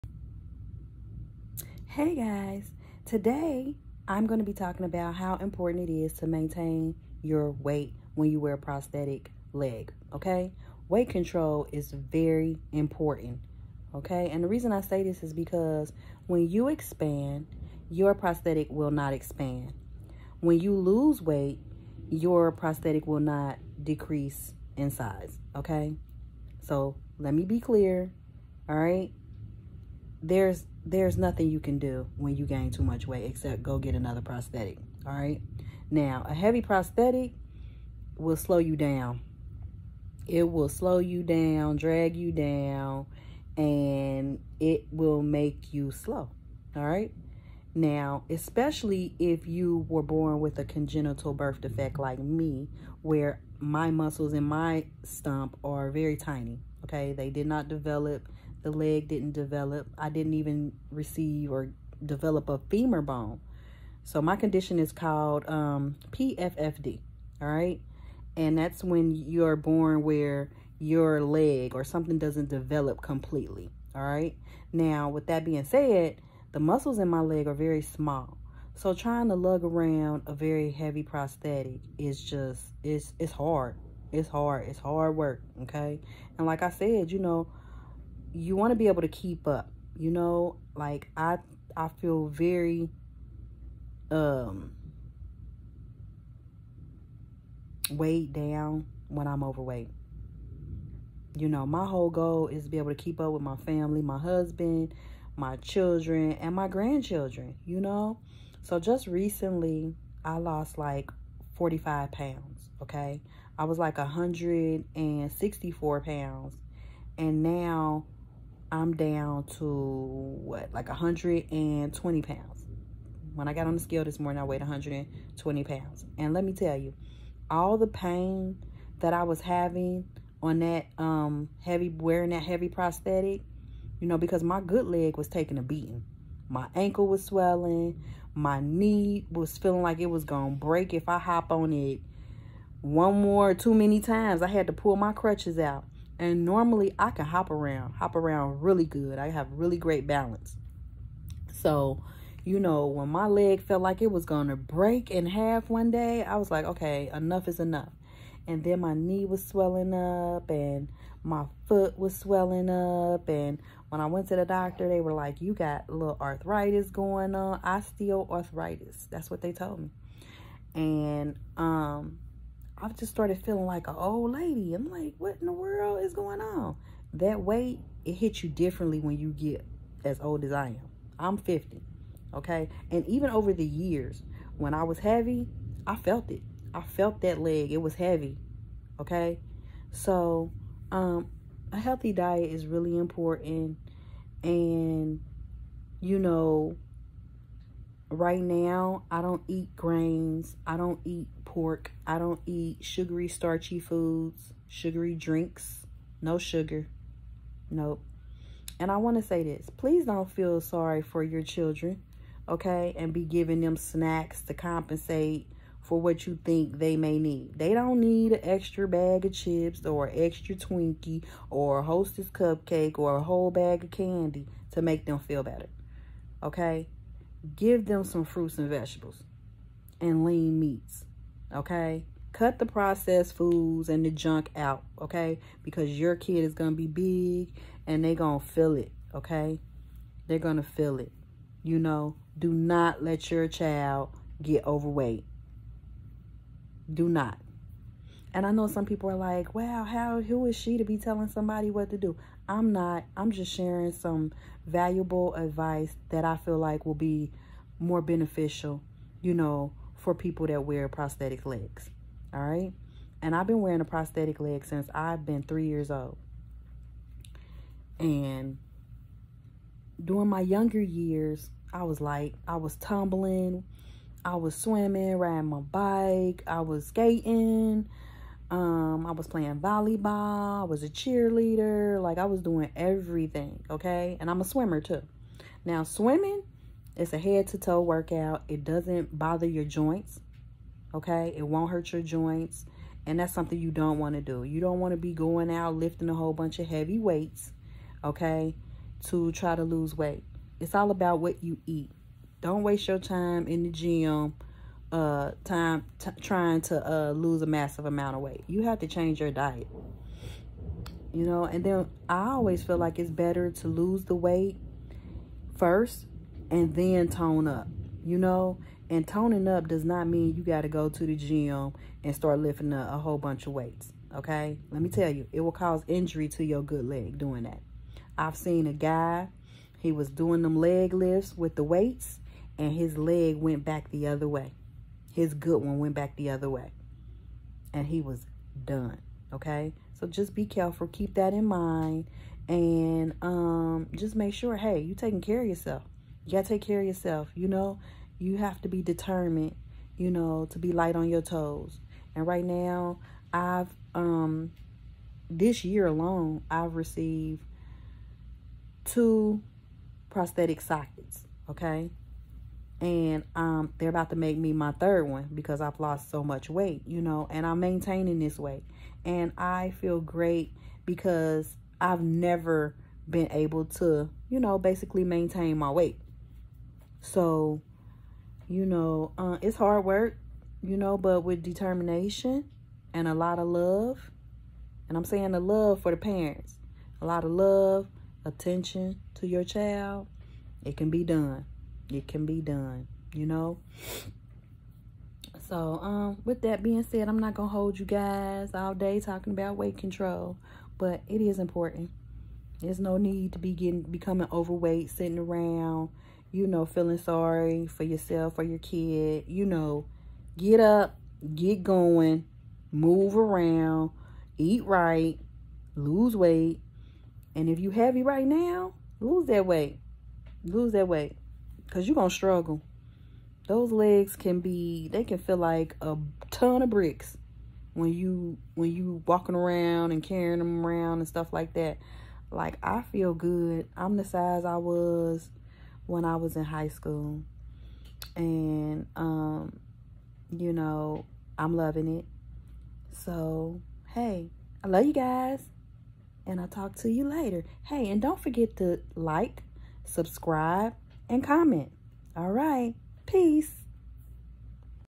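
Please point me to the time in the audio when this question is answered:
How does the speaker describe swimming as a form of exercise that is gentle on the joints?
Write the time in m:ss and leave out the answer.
4:47.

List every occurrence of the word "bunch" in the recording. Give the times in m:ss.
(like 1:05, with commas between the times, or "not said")
4:56, 5:23.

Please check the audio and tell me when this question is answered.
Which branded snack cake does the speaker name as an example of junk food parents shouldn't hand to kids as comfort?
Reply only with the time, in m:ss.
3:41.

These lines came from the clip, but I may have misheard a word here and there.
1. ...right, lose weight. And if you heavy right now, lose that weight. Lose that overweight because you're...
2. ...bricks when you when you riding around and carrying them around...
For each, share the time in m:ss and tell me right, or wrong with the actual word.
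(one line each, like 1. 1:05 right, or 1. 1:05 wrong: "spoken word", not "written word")
1. 6:54 wrong: "weight", not "overweight"
2. 7:06 wrong: "walking", not "riding".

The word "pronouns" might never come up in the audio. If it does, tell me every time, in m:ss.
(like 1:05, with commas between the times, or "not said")
not said.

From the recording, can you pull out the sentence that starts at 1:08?
And that's when you're born where your leg or something doesn't develop completely, all right?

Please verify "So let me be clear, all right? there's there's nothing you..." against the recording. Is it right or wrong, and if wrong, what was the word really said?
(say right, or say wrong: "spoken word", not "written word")
right.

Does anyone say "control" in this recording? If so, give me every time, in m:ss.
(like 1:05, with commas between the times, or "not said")
0:11, 6:39.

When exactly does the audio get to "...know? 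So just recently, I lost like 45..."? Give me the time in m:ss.
1:47.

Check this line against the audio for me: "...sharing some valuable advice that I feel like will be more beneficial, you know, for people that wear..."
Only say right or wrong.
right.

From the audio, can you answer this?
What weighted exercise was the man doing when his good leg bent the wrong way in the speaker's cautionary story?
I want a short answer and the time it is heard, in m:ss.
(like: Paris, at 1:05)
Leg lifts, at 5:30.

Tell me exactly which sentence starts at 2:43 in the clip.
And when I went to the doctor, they were like, you got a little arthritis going on, osteoarthritis.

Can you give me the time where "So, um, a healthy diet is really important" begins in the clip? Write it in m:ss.
3:09.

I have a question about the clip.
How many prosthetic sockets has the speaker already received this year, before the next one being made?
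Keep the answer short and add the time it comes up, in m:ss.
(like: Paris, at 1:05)
2, at 5:58.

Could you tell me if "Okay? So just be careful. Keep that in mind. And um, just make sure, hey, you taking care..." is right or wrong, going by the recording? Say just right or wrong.
right.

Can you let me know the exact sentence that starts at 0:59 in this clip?
I didn't even receive or develop a femur bone.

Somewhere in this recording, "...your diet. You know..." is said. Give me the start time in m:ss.
5:09.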